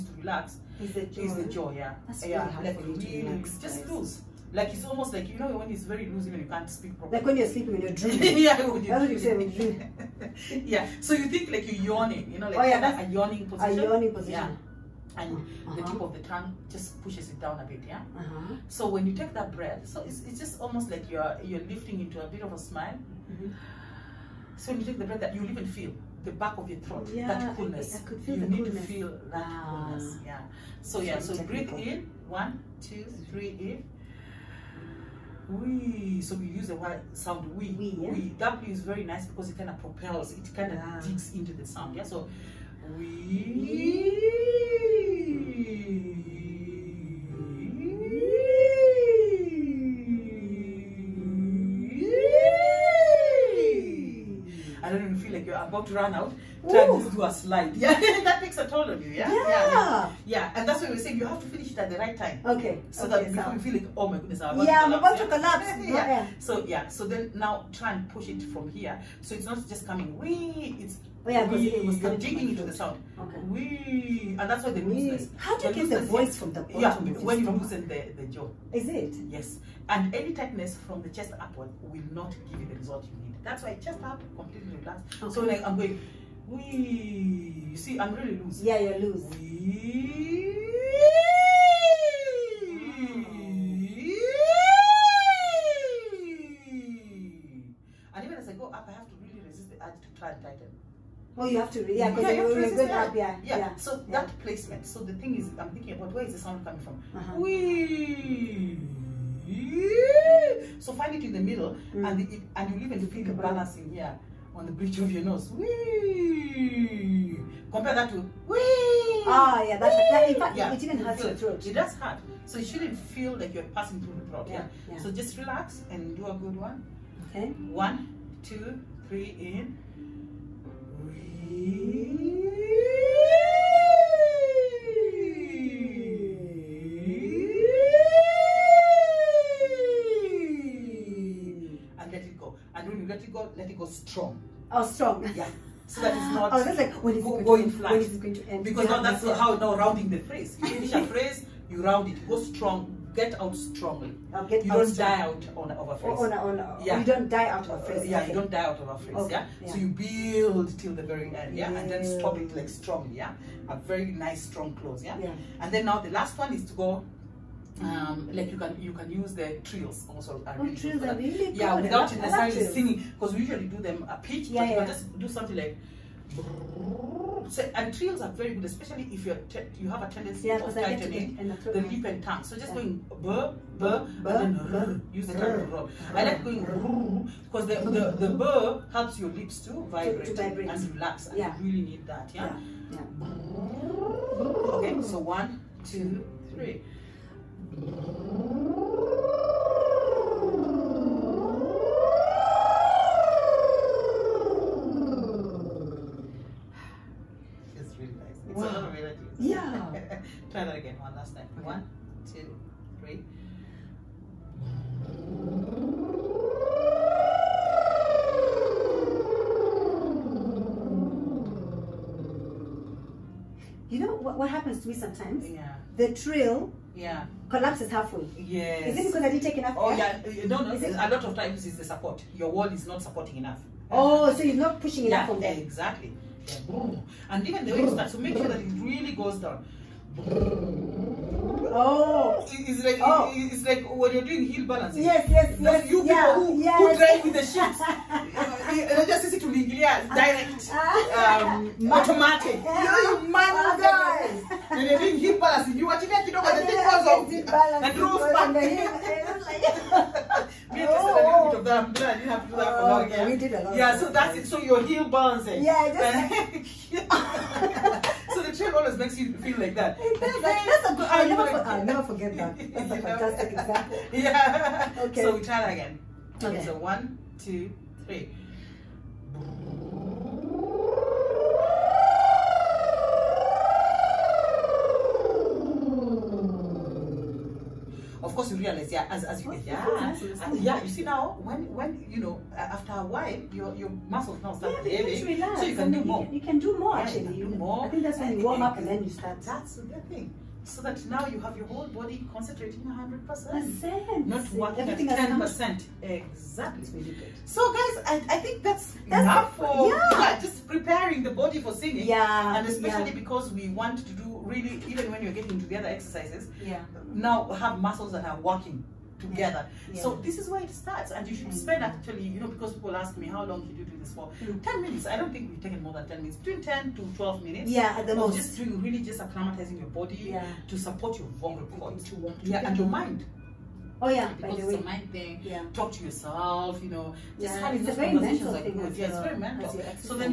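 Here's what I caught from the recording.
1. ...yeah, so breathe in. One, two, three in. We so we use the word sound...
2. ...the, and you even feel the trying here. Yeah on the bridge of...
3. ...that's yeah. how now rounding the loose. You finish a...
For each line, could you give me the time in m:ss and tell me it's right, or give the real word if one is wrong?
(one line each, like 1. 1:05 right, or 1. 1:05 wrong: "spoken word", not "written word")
1. 0:31 right
2. 1:52 wrong: "balancing", not "trying"
3. 2:29 wrong: "phrase", not "loose".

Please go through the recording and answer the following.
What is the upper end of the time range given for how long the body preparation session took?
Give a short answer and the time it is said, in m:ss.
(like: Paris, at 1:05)
12 minutes, at 5:27.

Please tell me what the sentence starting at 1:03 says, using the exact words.
feel like, oh my goodness, I'm about yeah, to collapse.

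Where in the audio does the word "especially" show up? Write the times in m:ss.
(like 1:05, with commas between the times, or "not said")
2:58, 5:12.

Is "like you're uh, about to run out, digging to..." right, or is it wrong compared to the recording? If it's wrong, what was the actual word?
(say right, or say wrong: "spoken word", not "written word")
wrong: "trying", not "digging".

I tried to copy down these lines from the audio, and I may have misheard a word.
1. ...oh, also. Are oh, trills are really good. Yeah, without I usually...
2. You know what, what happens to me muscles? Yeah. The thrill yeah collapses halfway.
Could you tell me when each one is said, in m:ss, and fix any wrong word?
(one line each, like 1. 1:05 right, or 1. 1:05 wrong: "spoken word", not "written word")
1. 2:50 wrong: "necessarily", not "usually"
2. 3:43 wrong: "sometimes", not "muscles".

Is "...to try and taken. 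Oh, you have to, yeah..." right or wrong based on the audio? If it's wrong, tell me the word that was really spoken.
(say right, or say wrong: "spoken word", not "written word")
wrong: "tighten", not "taken".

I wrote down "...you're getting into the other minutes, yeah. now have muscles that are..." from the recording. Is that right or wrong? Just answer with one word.
wrong.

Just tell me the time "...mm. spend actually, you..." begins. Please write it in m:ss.
5:21.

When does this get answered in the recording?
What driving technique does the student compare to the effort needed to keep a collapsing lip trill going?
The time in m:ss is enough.
4:04.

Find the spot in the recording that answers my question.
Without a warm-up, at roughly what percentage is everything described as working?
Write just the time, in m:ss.
5:05.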